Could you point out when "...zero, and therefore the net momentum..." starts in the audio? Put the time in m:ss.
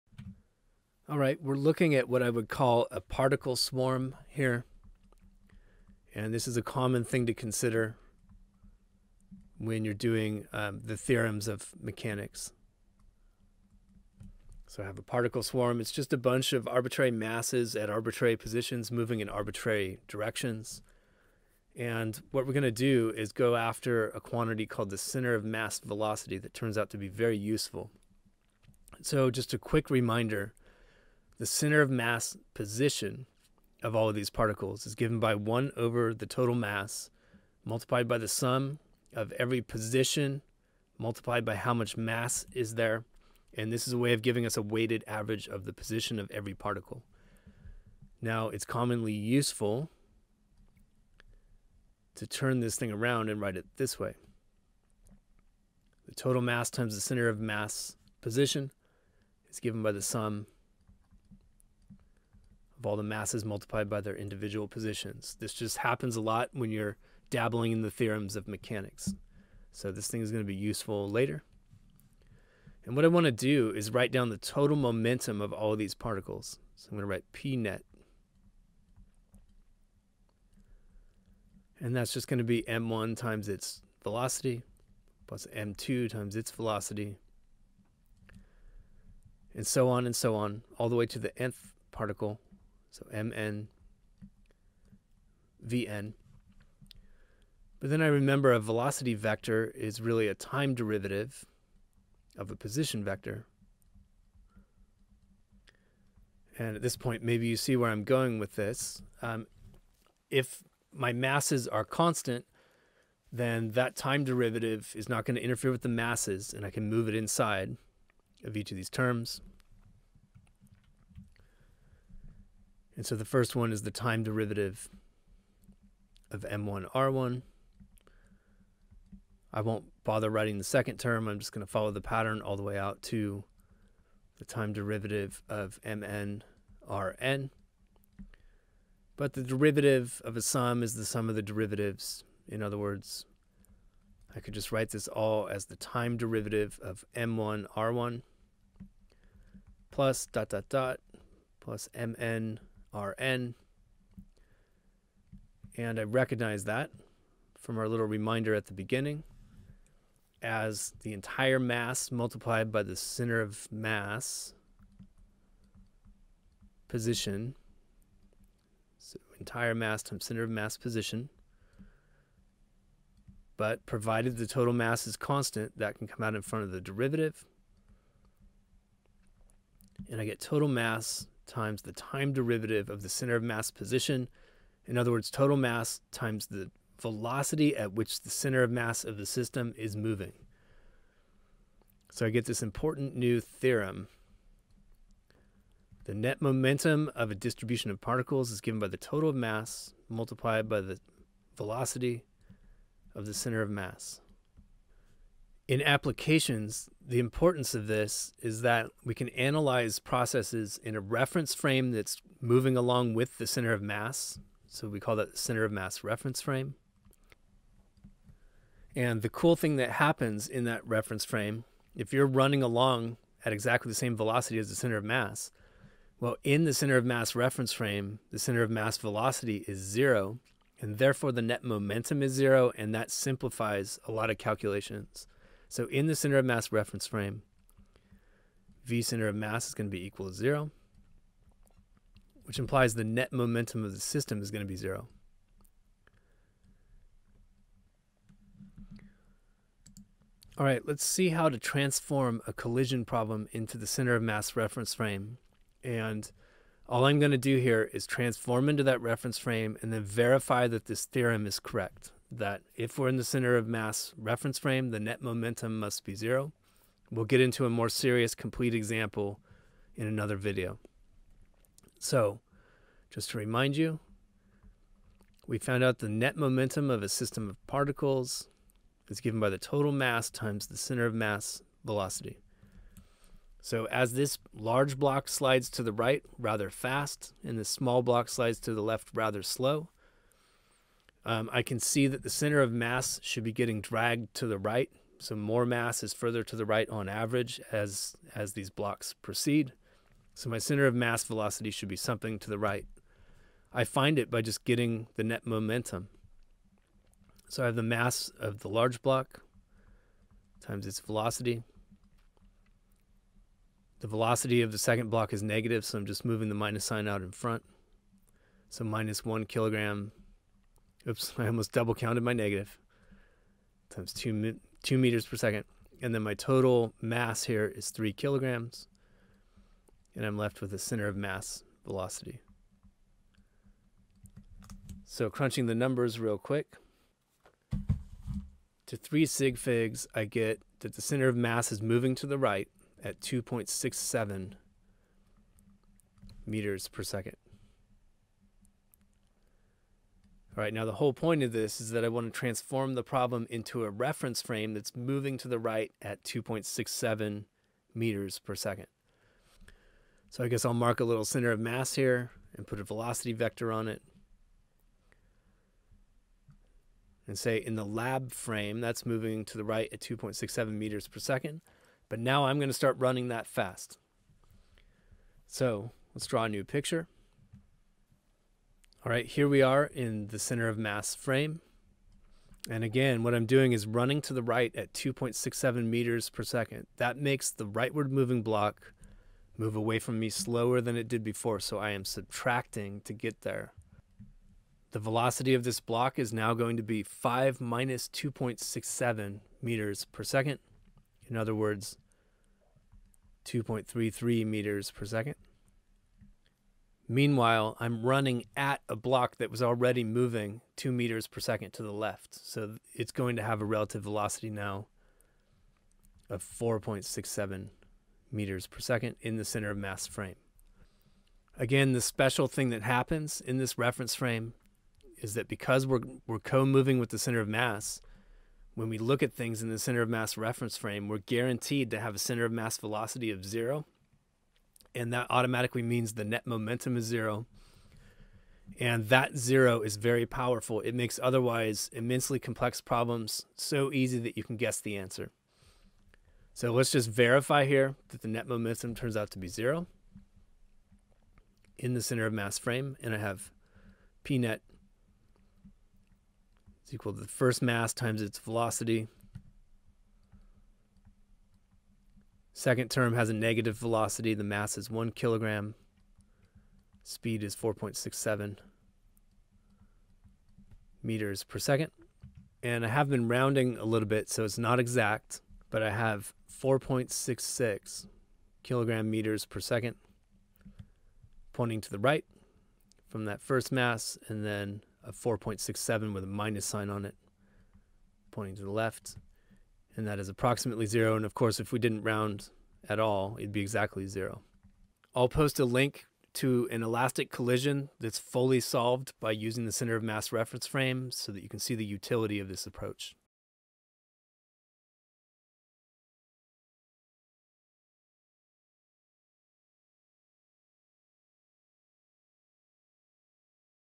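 3:49.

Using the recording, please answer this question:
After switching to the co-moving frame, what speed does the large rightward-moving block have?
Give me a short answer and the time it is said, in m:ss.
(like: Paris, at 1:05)
2.33 meters per second, at 6:43.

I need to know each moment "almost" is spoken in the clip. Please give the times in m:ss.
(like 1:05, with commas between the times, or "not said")
5:21.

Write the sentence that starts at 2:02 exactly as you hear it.
And so the first one is the time derivative of m1 r1.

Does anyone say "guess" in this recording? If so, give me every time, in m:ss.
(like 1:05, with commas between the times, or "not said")
6:00, 7:24.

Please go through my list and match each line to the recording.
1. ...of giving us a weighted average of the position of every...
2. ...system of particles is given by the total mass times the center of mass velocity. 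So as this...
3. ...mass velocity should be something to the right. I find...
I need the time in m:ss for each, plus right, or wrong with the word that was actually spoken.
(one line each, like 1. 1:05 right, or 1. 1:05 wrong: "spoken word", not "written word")
1. 0:44 right
2. 4:37 right
3. 5:00 right.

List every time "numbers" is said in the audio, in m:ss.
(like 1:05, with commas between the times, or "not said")
5:35.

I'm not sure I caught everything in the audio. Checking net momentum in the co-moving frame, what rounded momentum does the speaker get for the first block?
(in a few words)
4.66 kilogram meters per second.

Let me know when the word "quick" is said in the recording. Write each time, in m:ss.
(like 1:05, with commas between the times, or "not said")
0:29, 5:36.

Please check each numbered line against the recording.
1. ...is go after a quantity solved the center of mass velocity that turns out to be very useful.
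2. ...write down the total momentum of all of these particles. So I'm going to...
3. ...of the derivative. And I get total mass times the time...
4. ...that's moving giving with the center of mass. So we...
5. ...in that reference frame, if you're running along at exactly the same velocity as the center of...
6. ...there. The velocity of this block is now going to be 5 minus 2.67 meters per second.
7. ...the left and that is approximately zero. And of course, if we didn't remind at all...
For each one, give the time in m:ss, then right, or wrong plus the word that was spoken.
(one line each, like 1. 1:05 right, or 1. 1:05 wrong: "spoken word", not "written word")
1. 0:23 wrong: "called", not "solved"
2. 1:13 right
3. 2:56 right
4. 3:31 wrong: "along", not "giving"
5. 3:40 right
6. 6:33 right
7. 8:08 wrong: "round", not "remind".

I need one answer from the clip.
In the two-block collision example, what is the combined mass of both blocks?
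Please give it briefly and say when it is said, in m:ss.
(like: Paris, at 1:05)
3 kilograms, at 5:27.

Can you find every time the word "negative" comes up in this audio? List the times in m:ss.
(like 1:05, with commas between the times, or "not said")
5:15, 5:22, 7:43.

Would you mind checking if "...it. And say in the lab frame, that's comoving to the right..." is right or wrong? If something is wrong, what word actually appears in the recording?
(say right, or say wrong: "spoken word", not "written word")
wrong: "moving", not "comoving".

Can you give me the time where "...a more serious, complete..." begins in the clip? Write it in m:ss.
4:27.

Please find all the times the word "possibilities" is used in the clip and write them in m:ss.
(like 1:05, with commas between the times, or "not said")
not said.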